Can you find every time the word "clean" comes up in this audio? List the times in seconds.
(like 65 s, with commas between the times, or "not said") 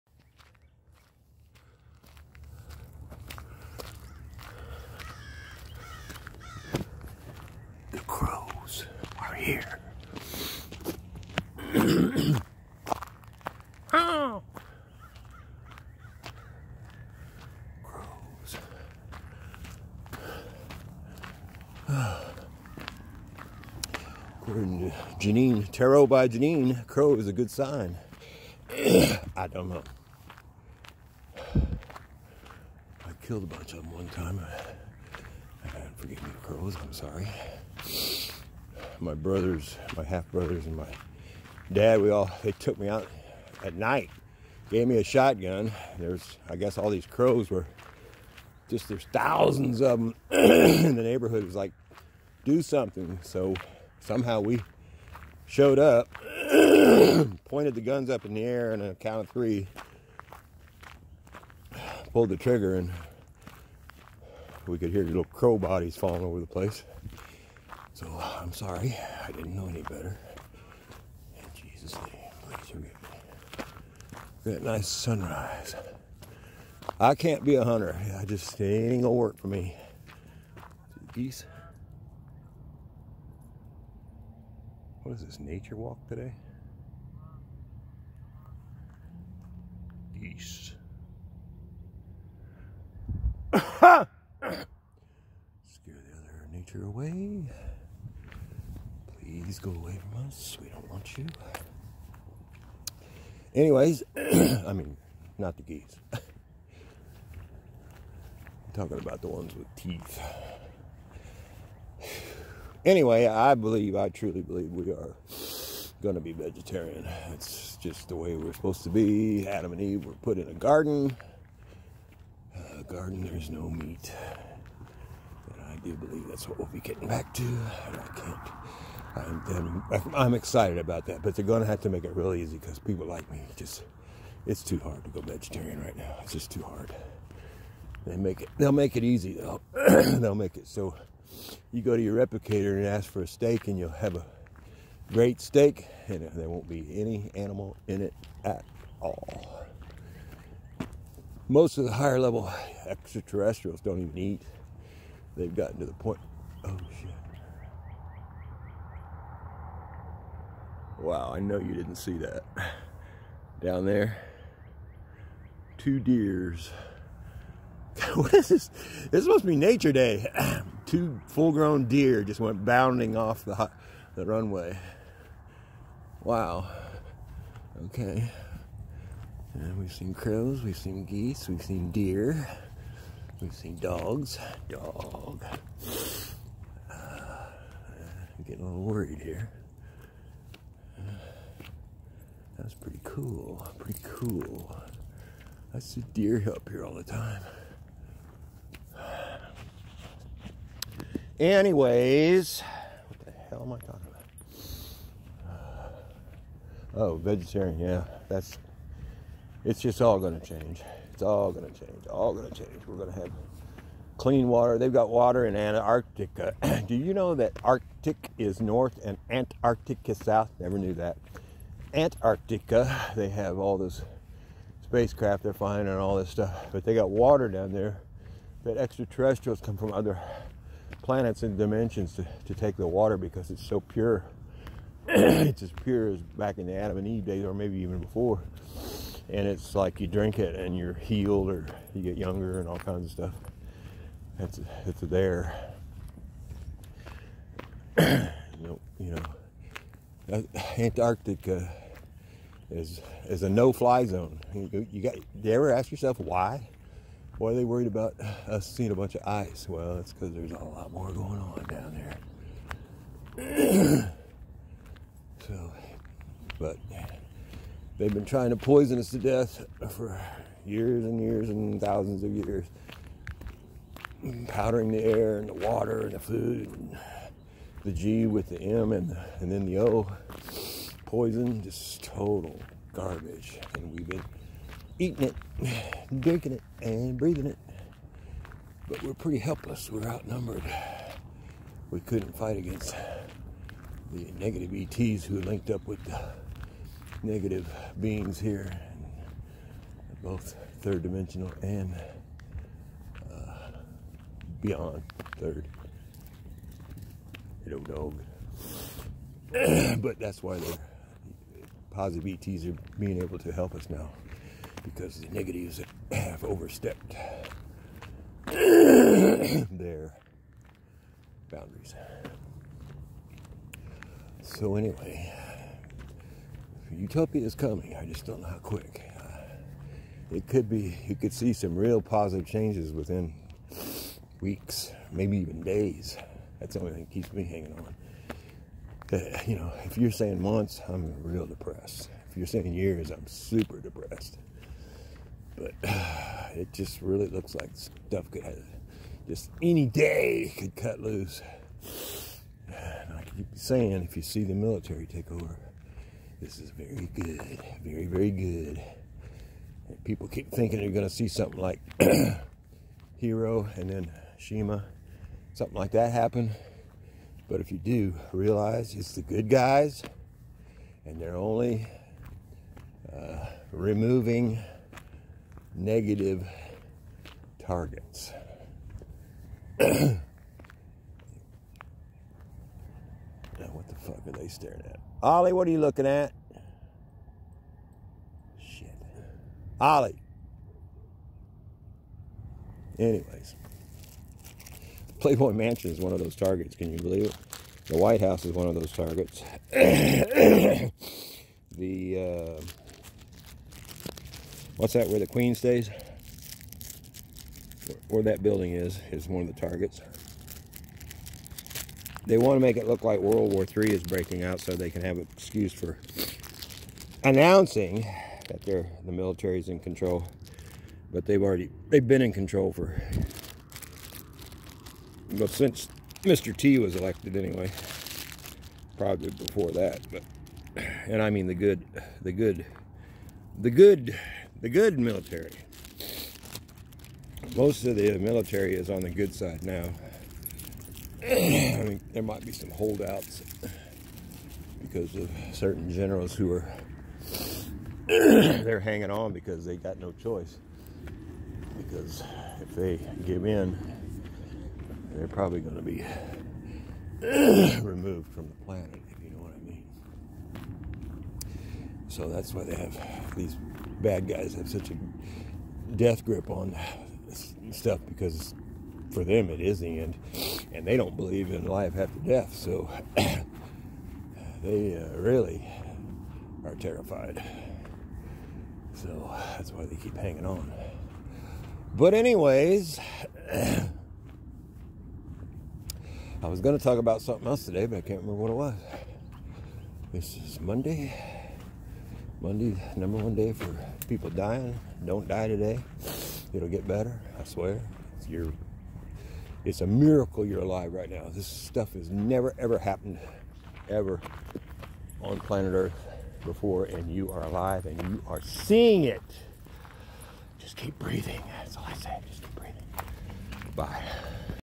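214 s.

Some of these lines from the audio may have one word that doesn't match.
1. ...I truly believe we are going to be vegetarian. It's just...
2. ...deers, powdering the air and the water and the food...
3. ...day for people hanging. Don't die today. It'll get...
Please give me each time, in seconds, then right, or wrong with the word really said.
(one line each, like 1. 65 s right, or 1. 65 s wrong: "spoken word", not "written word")
1. 113 s right
2. 272 s wrong: "years", not "deers"
3. 493 s wrong: "dying", not "hanging".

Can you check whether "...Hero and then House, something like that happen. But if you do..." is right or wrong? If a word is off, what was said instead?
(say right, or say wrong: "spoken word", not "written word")
wrong: "Shima", not "House".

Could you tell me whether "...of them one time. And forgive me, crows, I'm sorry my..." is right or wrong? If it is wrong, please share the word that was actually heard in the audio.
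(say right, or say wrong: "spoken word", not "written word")
right.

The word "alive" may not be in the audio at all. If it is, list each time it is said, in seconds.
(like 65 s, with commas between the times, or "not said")
500 s, 507 s.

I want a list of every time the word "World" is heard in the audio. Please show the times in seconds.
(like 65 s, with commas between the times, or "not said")
413 s.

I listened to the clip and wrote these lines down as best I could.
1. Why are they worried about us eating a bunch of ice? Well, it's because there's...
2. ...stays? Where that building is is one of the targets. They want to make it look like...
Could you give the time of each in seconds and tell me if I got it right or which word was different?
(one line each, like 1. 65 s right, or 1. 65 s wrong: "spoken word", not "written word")
1. 257 s wrong: "seeing", not "eating"
2. 405 s right.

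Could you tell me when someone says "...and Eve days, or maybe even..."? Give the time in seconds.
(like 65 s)
236 s.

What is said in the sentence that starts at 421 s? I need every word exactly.
But they've already they've been in control for well, since Mr.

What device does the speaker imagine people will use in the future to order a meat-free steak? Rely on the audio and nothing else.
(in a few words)
replicator.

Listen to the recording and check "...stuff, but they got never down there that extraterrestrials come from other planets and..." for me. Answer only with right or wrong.
wrong.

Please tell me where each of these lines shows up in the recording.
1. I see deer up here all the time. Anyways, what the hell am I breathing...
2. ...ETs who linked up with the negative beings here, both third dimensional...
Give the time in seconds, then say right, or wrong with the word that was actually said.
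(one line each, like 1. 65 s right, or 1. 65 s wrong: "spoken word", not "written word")
1. 195 s wrong: "talking", not "breathing"
2. 294 s right.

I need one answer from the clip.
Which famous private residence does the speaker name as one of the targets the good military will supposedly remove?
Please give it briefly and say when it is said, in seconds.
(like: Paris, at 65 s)
Playboy Mansion, at 395 s.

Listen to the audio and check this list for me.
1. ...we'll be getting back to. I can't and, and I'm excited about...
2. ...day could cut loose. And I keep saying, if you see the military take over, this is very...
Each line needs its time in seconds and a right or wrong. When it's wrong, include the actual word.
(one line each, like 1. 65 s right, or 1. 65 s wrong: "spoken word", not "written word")
1. 126 s right
2. 349 s right.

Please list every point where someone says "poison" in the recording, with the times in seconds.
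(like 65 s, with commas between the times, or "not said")
268 s, 281 s.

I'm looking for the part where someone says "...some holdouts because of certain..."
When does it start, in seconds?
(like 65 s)
442 s.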